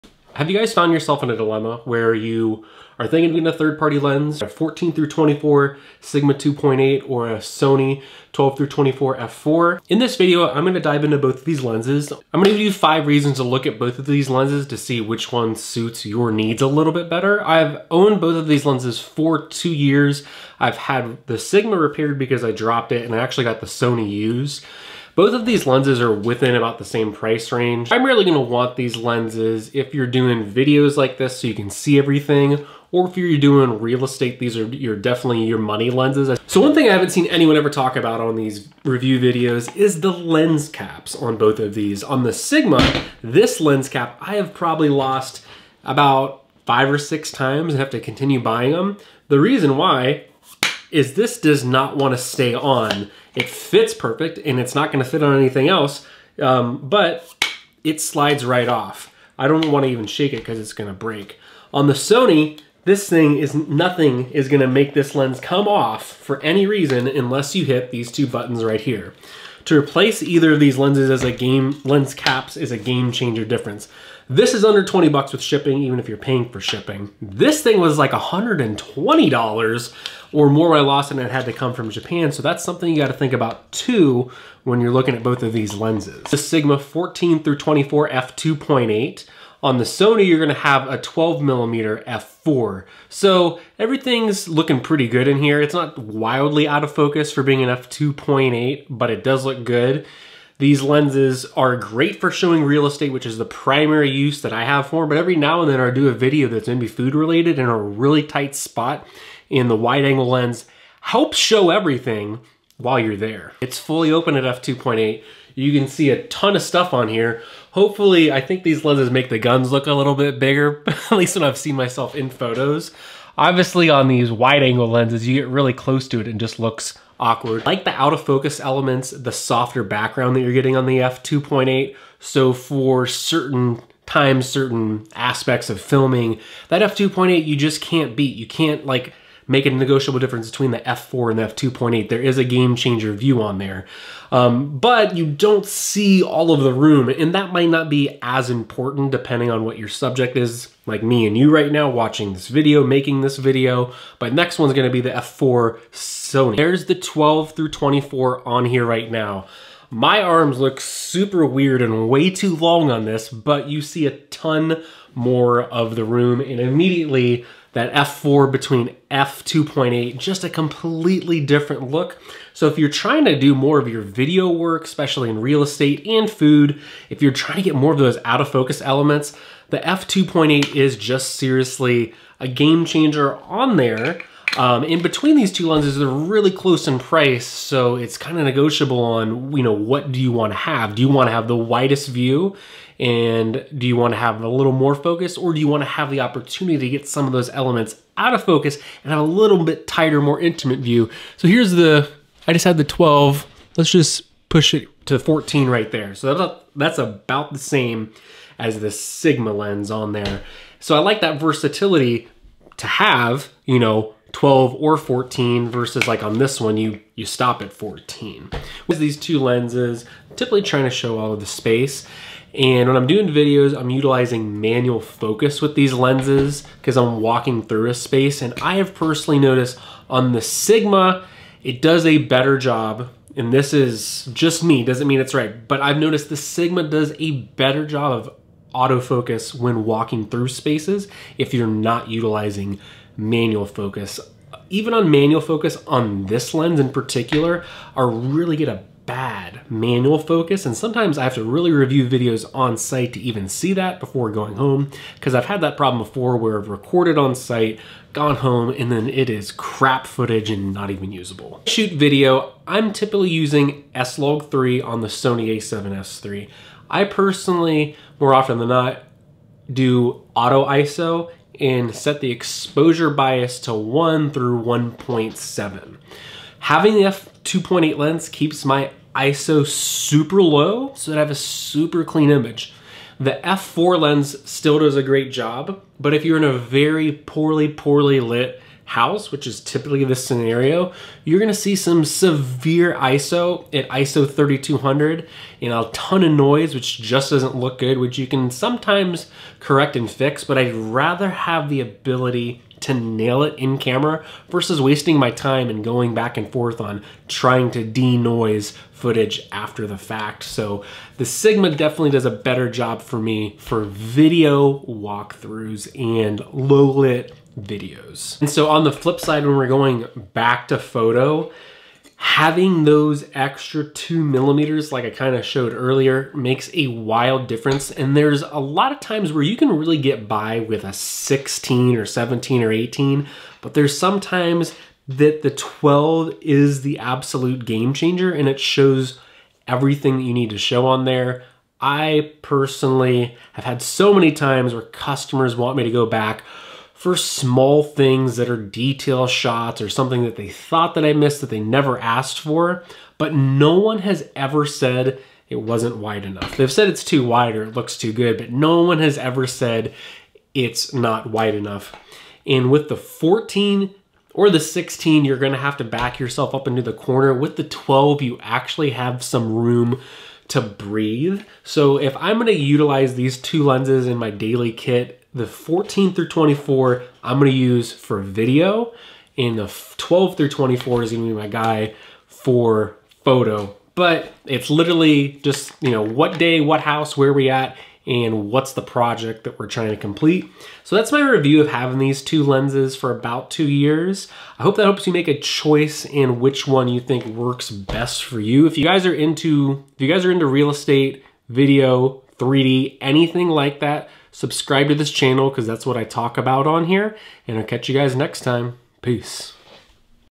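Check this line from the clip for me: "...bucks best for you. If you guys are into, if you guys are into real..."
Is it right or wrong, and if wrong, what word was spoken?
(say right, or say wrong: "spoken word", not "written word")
wrong: "works", not "bucks".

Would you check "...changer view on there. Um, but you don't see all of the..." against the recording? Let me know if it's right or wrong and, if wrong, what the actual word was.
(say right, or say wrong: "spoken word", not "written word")
right.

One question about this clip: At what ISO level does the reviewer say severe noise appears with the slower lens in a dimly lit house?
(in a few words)
3200.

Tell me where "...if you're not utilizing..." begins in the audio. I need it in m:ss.
4:01.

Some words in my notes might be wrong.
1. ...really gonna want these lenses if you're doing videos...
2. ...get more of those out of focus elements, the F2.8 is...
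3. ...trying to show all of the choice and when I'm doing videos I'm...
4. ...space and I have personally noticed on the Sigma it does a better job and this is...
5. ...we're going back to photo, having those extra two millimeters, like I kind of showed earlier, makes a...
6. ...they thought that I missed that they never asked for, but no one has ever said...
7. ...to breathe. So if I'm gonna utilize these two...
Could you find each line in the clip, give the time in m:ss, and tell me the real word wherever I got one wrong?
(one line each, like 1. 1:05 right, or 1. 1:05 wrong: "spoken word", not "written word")
1. 0:28 right
2. 2:57 right
3. 3:40 wrong: "space", not "choice"
4. 3:47 right
5. 5:19 right
6. 5:50 right
7. 6:10 right.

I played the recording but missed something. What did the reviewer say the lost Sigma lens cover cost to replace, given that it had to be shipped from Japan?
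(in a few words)
$120.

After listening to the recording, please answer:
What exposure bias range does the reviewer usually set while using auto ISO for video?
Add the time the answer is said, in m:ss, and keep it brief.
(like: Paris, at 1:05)
1 to 1.7, at 4:33.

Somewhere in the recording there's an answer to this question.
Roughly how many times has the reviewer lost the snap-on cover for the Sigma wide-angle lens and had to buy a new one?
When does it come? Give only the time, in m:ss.
0:45.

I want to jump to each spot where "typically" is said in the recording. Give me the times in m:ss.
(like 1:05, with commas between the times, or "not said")
3:40, 4:22, 4:49.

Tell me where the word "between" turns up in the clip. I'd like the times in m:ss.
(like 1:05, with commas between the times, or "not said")
2:20, 2:48, 3:05.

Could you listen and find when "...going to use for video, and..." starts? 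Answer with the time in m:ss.
6:17.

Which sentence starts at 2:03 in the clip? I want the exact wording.
Obviously on these wide angle lenses, you get really close to it and just looks awkward.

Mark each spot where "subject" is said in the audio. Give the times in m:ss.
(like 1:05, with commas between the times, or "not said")
2:29.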